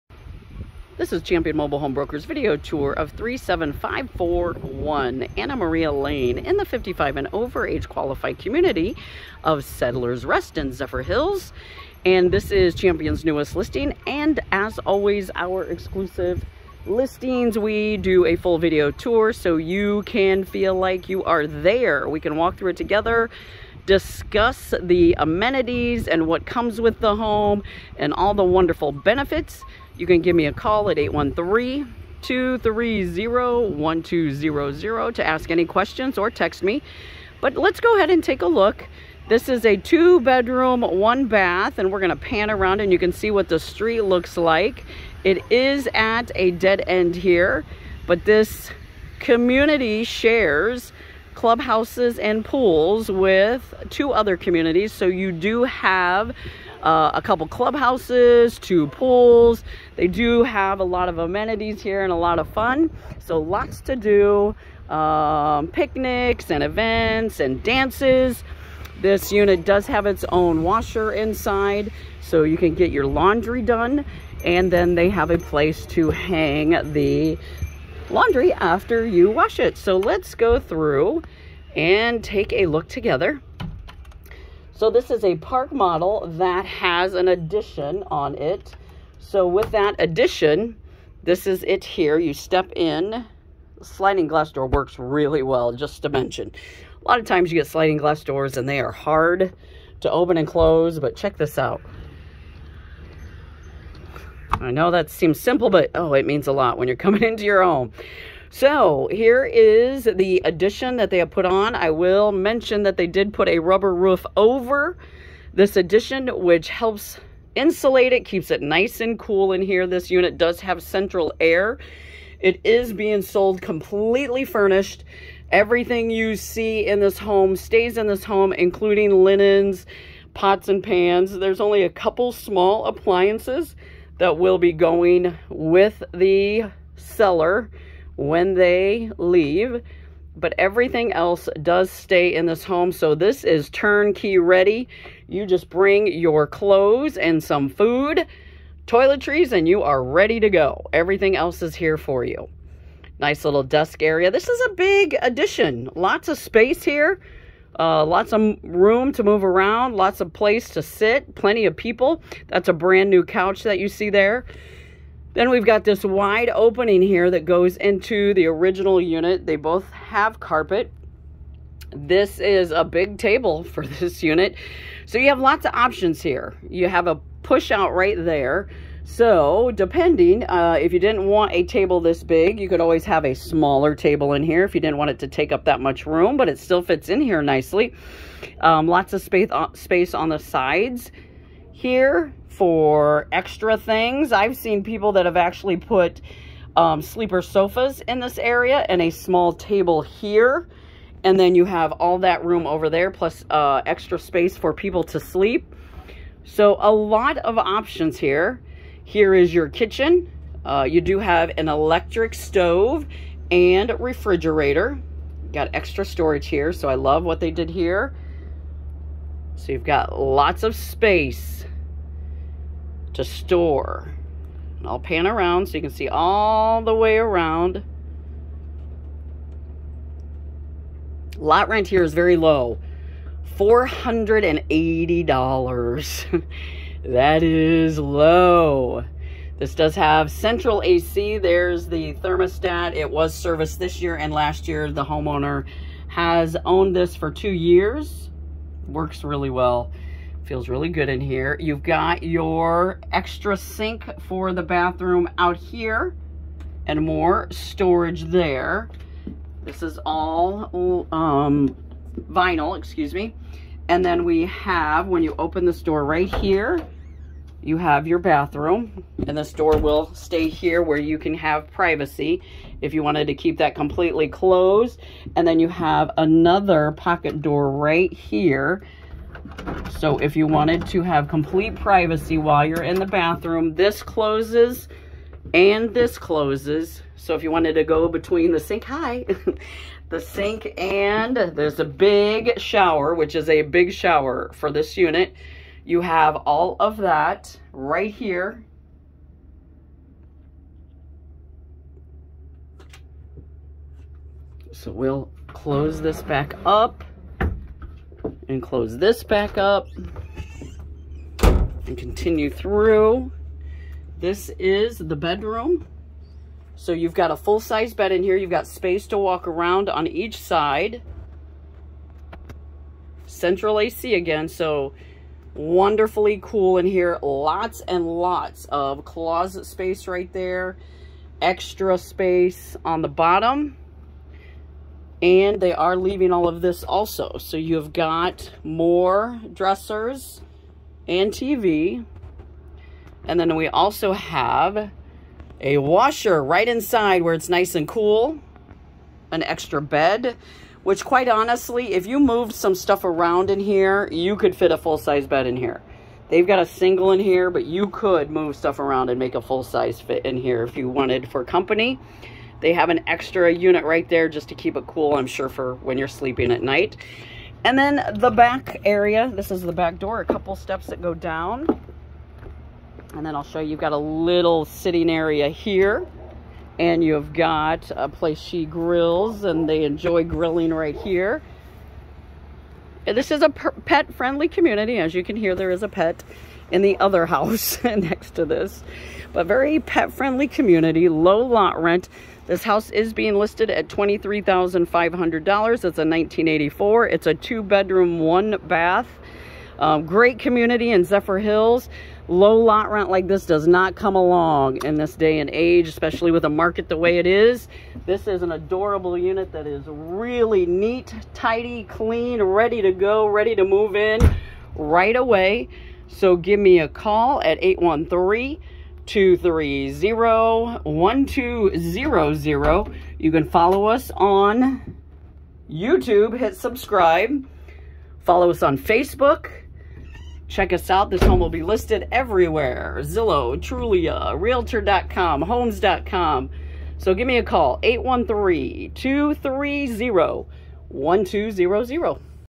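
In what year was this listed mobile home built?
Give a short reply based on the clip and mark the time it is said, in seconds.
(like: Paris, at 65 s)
1984, at 395 s.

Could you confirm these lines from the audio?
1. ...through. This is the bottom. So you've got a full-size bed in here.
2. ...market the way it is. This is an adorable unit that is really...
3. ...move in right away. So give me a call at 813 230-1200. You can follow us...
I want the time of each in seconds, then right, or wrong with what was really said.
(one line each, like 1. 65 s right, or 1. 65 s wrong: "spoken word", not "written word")
1. 312 s wrong: "bedroom", not "bottom"
2. 406 s right
3. 413 s right.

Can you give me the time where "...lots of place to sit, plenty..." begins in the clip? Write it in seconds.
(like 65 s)
159 s.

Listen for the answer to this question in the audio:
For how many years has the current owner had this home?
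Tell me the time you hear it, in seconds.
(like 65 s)
247 s.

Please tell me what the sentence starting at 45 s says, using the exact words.
It is at a dead end here, but this community shares clubhouses and pools with two other communities.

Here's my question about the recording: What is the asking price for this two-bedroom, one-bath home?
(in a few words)
$23,500.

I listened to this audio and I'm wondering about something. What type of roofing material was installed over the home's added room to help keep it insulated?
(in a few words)
rubber roof.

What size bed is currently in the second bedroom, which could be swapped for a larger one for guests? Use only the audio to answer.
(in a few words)
single.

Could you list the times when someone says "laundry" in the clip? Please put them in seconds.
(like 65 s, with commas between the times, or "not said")
73 s, 78 s.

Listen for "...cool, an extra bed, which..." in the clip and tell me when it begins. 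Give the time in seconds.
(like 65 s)
347 s.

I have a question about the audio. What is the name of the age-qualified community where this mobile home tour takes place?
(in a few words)
Settlers Rest.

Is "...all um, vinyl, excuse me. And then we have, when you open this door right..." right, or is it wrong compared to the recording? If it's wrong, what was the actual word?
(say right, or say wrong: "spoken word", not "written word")
right.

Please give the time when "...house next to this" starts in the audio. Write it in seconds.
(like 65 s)
387 s.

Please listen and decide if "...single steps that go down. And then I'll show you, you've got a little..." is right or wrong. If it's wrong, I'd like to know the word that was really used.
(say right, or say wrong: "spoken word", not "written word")
wrong: "couple", not "single".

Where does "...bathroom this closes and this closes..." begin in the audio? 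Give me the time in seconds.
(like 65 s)
283 s.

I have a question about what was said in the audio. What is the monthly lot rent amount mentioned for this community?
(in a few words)
$480.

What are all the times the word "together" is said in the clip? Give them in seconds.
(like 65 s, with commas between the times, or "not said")
22 s, 82 s.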